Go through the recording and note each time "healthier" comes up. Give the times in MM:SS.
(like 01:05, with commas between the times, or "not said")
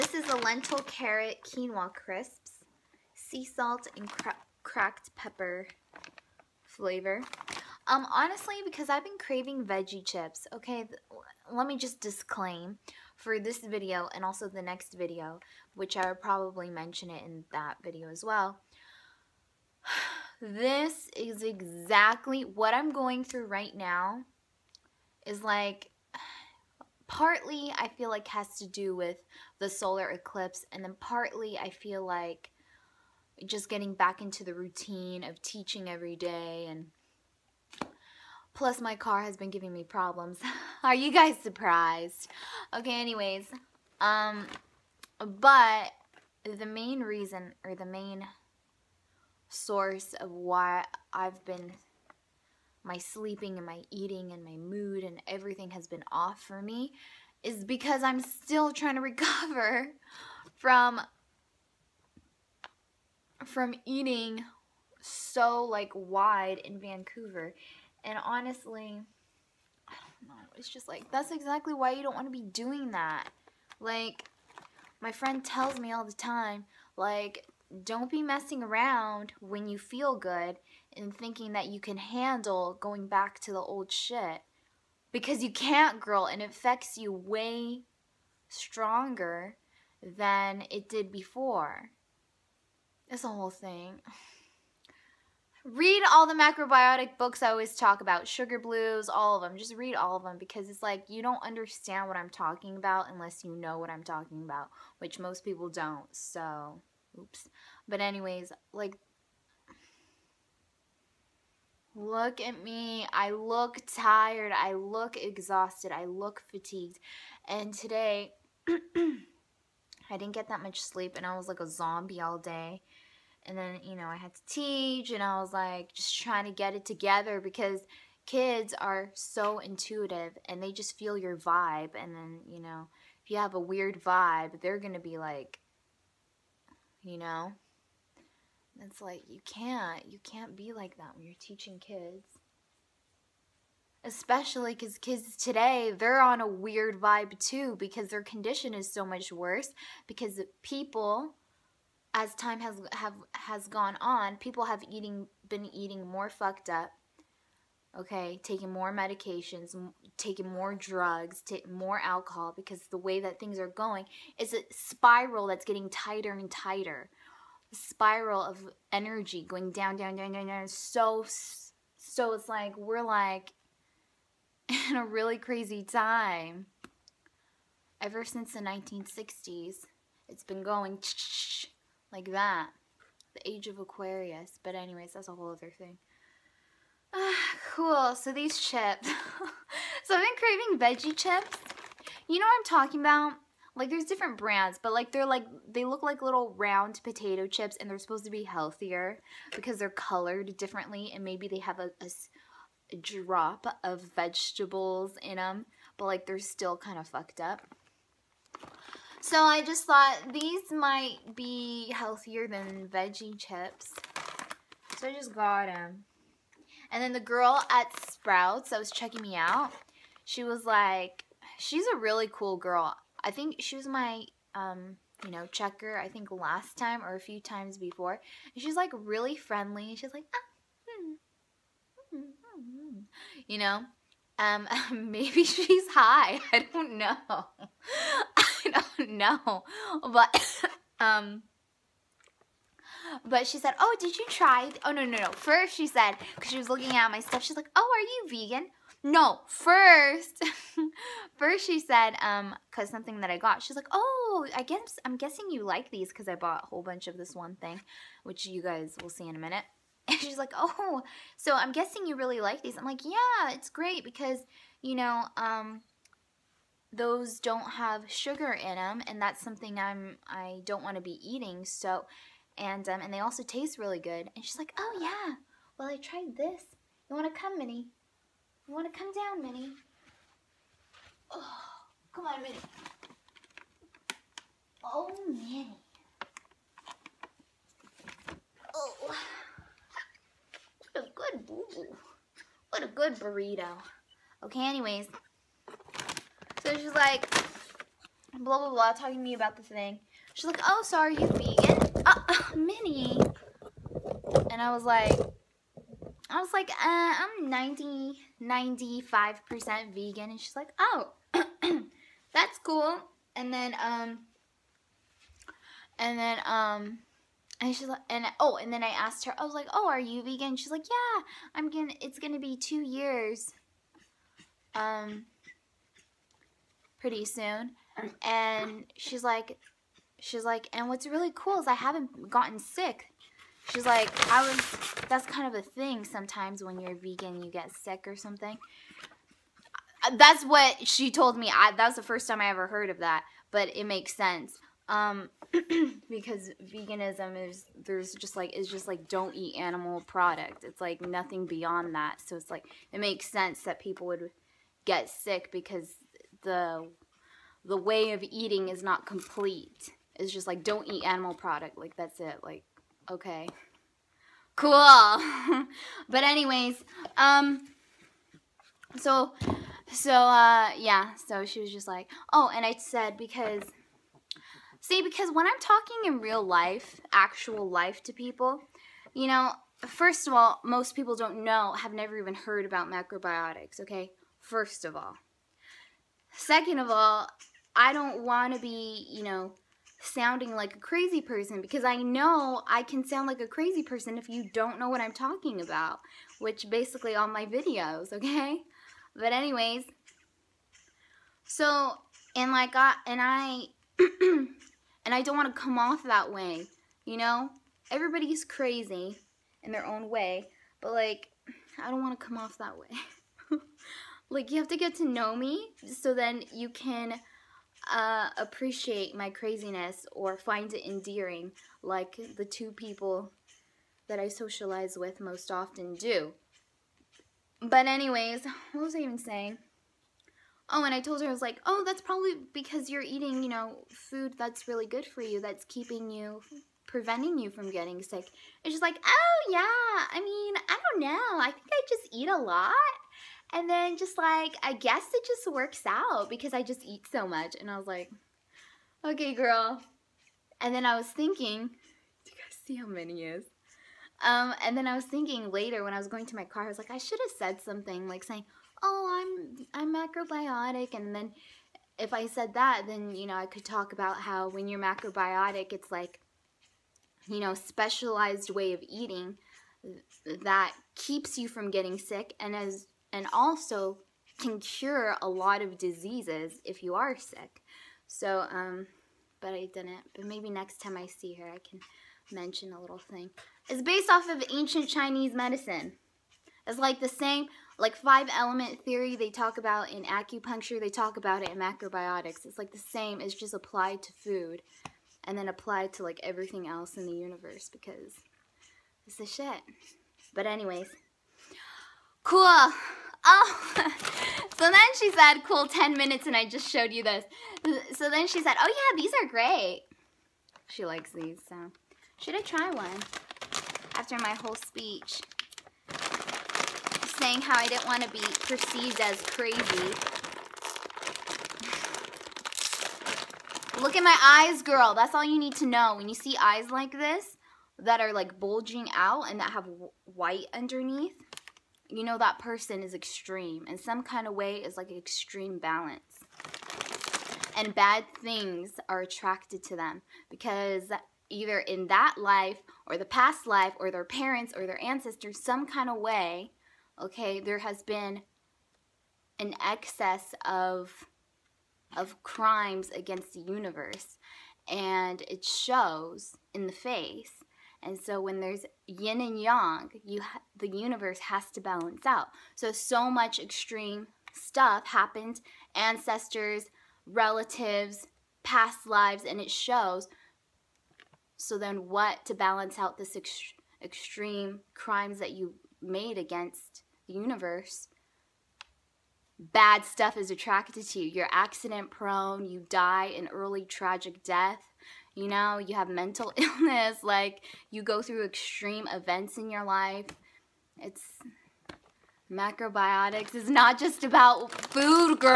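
03:18, 03:31.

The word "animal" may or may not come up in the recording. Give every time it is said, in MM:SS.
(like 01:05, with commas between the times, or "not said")
05:49, 06:01.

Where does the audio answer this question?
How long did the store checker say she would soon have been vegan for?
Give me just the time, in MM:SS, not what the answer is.
05:22.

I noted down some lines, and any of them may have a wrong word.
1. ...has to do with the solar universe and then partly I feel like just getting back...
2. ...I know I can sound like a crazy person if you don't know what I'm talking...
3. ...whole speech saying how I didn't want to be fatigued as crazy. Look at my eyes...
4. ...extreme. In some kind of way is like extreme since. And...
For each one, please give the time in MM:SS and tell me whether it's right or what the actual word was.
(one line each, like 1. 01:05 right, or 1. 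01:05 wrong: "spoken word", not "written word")
1. 00:28 wrong: "eclipse", not "universe"
2. 06:31 right
3. 08:34 wrong: "perceived", not "fatigued"
4. 08:52 wrong: "balance", not "since".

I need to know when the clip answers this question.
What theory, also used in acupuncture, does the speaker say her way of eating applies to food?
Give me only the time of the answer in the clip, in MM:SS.
08:07.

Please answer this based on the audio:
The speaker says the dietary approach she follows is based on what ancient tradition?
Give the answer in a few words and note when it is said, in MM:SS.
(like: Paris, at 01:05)
Ancient Chinese medicine, at 08:04.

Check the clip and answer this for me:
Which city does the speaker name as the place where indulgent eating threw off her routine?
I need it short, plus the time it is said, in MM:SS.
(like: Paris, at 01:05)
Vancouver, at 01:06.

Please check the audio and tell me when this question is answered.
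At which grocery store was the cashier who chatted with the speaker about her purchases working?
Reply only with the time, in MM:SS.
03:38.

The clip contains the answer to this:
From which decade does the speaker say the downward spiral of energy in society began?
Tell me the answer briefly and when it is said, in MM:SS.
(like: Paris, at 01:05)
1960s, at 02:58.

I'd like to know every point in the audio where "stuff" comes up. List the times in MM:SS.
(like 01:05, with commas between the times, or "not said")
04:07, 09:24, 09:39.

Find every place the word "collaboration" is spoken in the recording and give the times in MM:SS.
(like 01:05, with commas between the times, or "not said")
not said.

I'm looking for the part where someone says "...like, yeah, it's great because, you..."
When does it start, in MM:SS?
04:22.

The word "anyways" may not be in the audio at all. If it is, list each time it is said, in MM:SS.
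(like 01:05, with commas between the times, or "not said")
00:42, 01:47, 03:04, 04:54, 06:06, 06:39, 07:07, 08:20.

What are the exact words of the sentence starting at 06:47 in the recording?
Everybody's crazy in their own way, but like, I don't want to come off that way.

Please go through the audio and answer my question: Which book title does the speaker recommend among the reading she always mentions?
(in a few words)
Sugar Blues.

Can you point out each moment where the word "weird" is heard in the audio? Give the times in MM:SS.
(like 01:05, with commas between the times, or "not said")
02:13, 02:26.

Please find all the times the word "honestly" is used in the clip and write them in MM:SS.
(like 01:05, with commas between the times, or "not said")
00:08, 01:08.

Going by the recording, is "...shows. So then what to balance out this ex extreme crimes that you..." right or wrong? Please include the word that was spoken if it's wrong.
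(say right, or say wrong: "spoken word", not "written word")
right.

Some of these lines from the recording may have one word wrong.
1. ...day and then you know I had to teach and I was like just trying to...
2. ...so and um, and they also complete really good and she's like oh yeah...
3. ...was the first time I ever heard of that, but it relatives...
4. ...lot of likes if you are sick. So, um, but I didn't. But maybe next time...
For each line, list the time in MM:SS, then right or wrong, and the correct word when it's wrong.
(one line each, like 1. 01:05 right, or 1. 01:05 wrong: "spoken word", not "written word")
1. 02:02 right
2. 04:31 wrong: "taste", not "complete"
3. 05:41 wrong: "makes", not "relatives"
4. 07:55 wrong: "diseases", not "likes".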